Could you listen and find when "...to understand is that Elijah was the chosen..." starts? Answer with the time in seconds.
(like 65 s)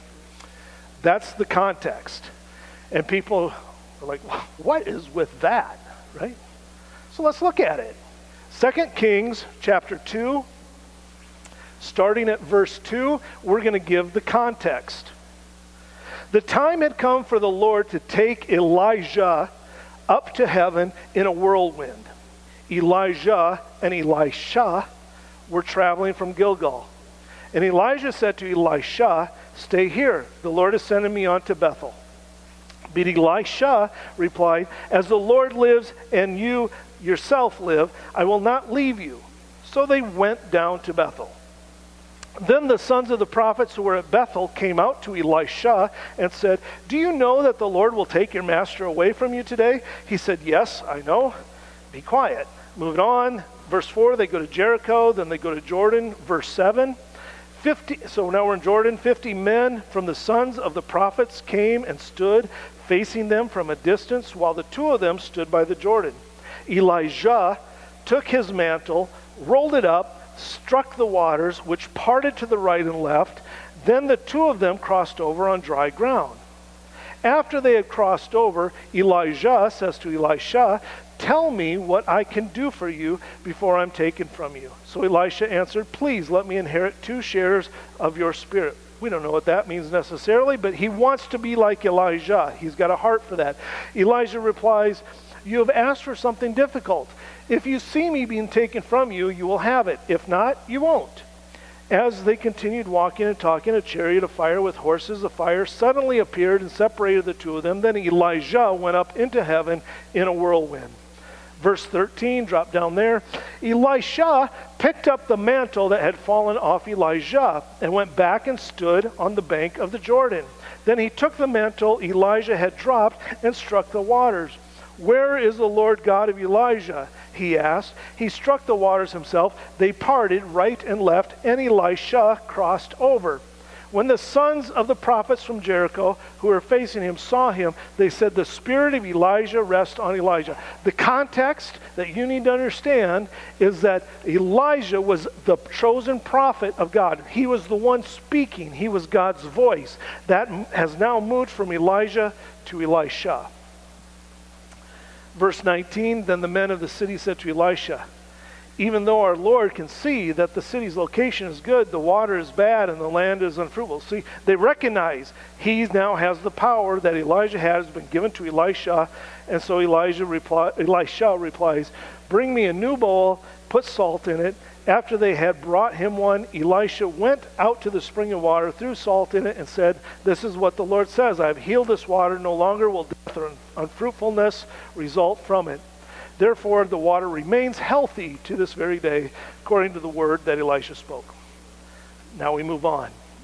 142 s.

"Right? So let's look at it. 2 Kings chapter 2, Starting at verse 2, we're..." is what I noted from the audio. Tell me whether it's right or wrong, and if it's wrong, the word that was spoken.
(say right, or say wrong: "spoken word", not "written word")
right.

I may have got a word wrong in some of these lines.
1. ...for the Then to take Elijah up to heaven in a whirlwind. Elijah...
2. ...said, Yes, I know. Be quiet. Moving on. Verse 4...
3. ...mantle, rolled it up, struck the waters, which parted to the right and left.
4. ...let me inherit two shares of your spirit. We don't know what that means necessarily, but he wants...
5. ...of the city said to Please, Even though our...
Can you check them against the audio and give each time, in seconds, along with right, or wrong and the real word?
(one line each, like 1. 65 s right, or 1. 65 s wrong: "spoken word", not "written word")
1. 17 s wrong: "Lord", not "Then"
2. 50 s right
3. 68 s right
4. 86 s right
5. 156 s wrong: "Elisha", not "Please".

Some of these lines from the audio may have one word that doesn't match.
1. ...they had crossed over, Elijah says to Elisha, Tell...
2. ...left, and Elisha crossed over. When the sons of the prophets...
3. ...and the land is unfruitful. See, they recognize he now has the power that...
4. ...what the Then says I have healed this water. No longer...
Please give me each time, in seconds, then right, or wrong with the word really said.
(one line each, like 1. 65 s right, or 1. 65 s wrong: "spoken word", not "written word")
1. 77 s right
2. 131 s right
3. 162 s right
4. 180 s wrong: "Lord", not "Then".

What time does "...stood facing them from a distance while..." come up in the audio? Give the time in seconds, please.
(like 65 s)
61 s.